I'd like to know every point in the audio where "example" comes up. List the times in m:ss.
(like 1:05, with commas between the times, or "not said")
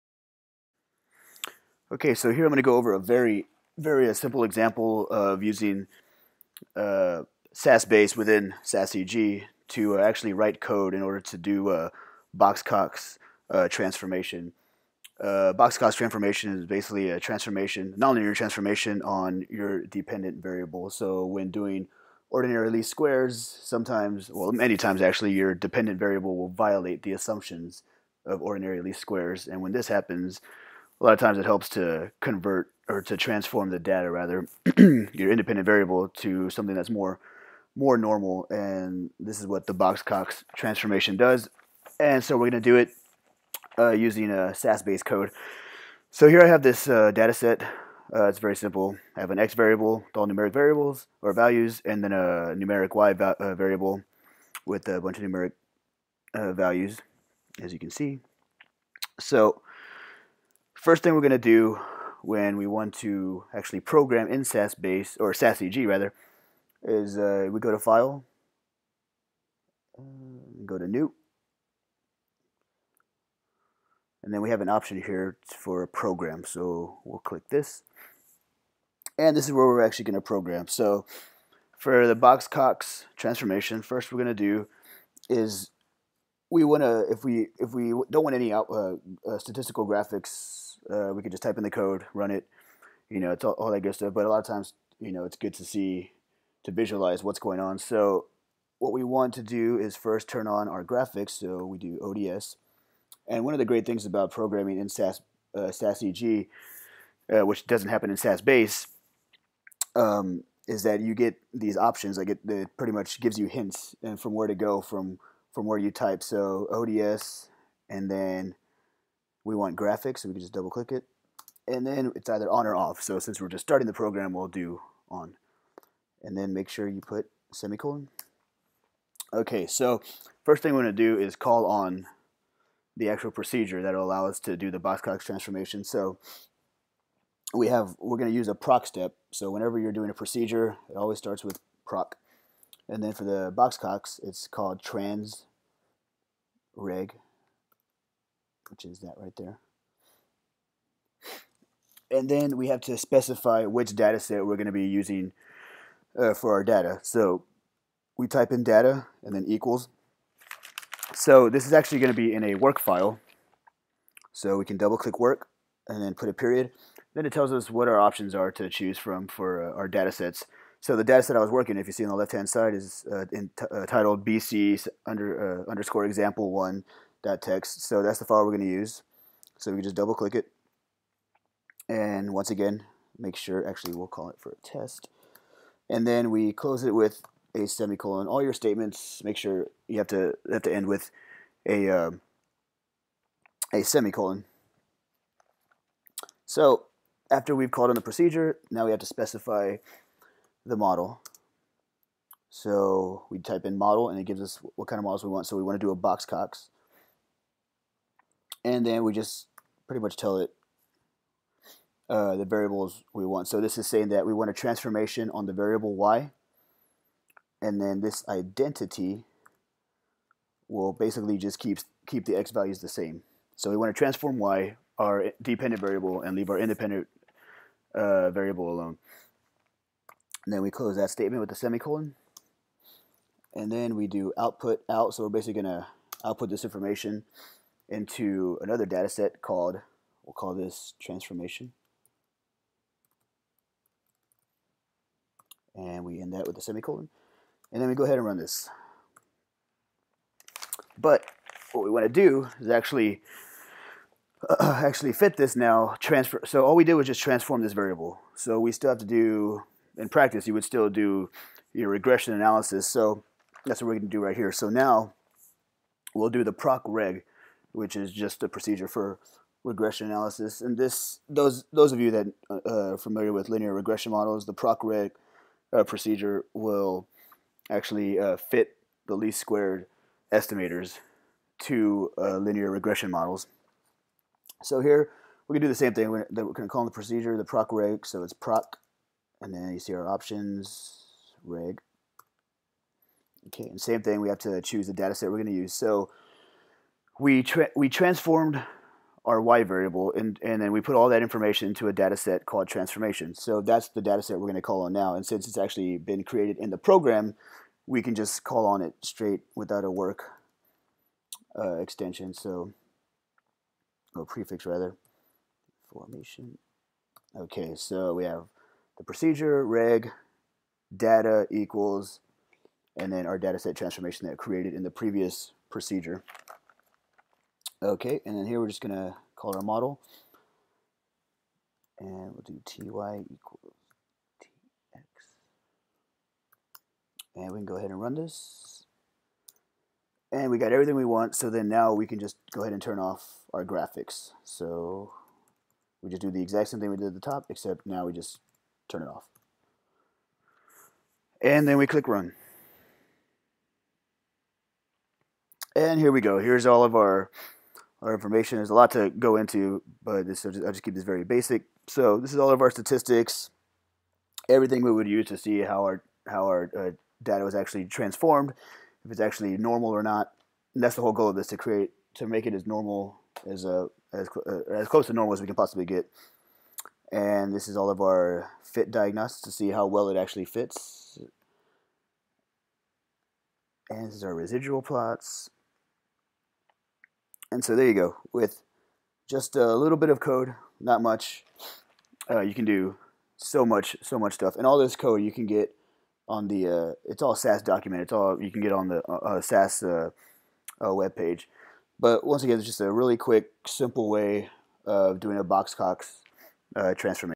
0:04, 2:56.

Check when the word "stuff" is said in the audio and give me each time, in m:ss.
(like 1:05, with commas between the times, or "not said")
1:33, 6:34.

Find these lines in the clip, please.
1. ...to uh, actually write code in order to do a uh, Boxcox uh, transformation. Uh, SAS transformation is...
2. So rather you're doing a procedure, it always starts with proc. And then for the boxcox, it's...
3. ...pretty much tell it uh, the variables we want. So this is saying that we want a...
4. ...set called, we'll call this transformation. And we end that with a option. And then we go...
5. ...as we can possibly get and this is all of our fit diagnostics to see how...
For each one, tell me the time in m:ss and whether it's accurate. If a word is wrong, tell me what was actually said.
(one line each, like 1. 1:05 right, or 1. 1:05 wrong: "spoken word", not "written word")
1. 0:09 wrong: "Boxcox", not "SAS"
2. 2:19 wrong: "whenever", not "rather"
3. 3:29 right
4. 3:59 wrong: "semicolon", not "option"
5. 6:15 right.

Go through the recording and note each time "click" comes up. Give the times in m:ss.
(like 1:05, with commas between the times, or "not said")
1:17, 2:00, 2:44, 3:00, 5:51.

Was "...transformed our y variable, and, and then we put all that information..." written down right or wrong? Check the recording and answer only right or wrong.
right.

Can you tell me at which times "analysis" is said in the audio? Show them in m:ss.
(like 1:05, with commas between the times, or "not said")
4:22, 4:30.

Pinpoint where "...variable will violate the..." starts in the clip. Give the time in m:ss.
0:25.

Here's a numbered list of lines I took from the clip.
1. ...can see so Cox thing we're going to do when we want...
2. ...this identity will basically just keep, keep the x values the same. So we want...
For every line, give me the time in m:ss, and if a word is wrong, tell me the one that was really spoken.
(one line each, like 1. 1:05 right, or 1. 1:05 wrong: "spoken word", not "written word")
1. 0:57 wrong: "First", not "Cox"
2. 3:38 right.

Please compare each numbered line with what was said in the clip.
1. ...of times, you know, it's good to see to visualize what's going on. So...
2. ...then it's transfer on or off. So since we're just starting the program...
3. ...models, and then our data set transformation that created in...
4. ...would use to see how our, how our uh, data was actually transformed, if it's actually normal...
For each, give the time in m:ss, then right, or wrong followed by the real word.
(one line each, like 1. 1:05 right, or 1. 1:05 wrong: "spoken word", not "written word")
1. 1:34 right
2. 2:01 wrong: "either", not "transfer"
3. 5:21 wrong: "equals", not "models"
4. 6:04 right.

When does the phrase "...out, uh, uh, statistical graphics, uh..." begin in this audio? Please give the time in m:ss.
1:28.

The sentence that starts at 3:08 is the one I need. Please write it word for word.
All your statements, make sure you have to have to end with a um, a semicolon.